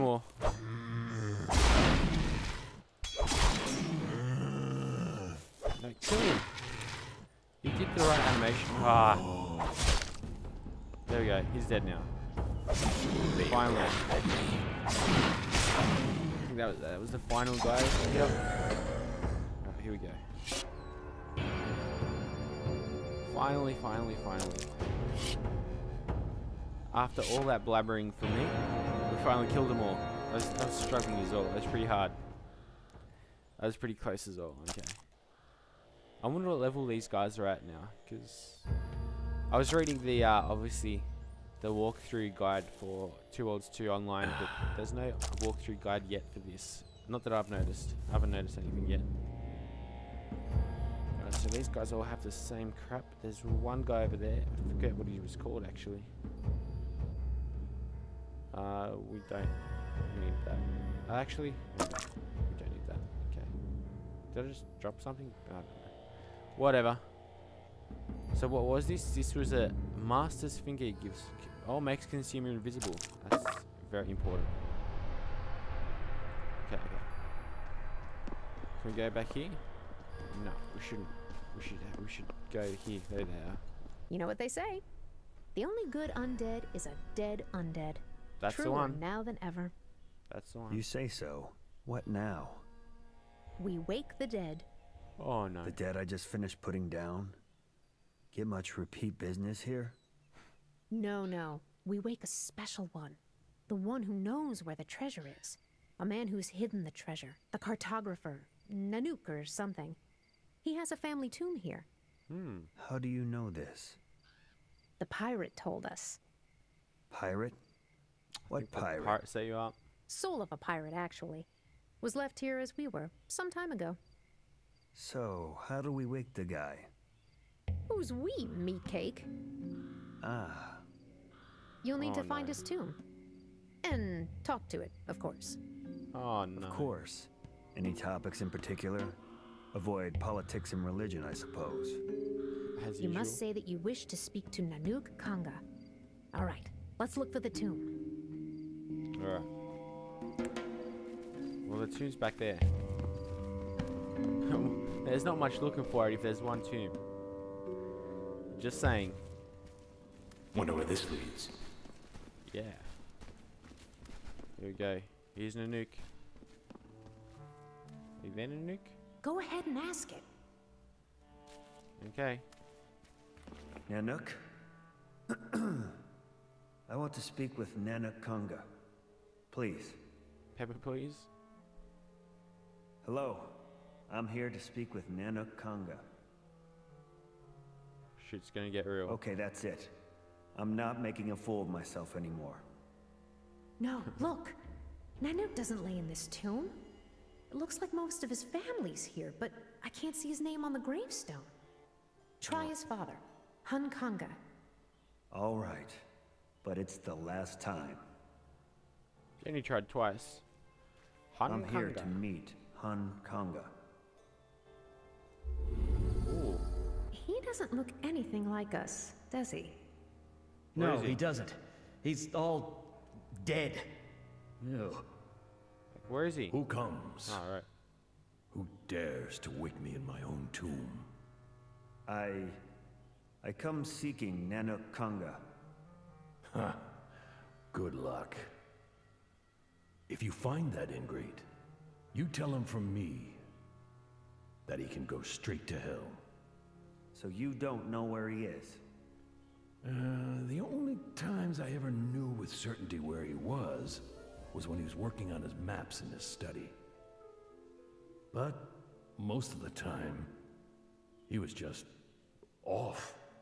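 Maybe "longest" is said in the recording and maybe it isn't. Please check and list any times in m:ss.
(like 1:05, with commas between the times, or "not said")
not said.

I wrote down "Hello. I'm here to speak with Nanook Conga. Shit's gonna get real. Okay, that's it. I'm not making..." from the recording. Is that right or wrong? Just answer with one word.
right.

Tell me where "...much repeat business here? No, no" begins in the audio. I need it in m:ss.
1:38.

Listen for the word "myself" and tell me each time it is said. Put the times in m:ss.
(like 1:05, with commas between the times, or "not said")
3:11.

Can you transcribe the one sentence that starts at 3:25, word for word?
All right, but it's the last time.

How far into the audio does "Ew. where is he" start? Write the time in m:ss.
3:44.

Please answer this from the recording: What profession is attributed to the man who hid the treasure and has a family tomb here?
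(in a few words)
Cartographer.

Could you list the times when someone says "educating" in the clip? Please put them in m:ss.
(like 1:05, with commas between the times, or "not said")
not said.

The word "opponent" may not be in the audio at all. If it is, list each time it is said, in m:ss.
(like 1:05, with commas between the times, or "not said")
not said.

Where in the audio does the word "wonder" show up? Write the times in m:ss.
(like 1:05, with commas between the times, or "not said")
0:36, 2:40.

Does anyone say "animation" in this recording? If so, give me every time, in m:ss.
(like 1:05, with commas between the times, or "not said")
0:08.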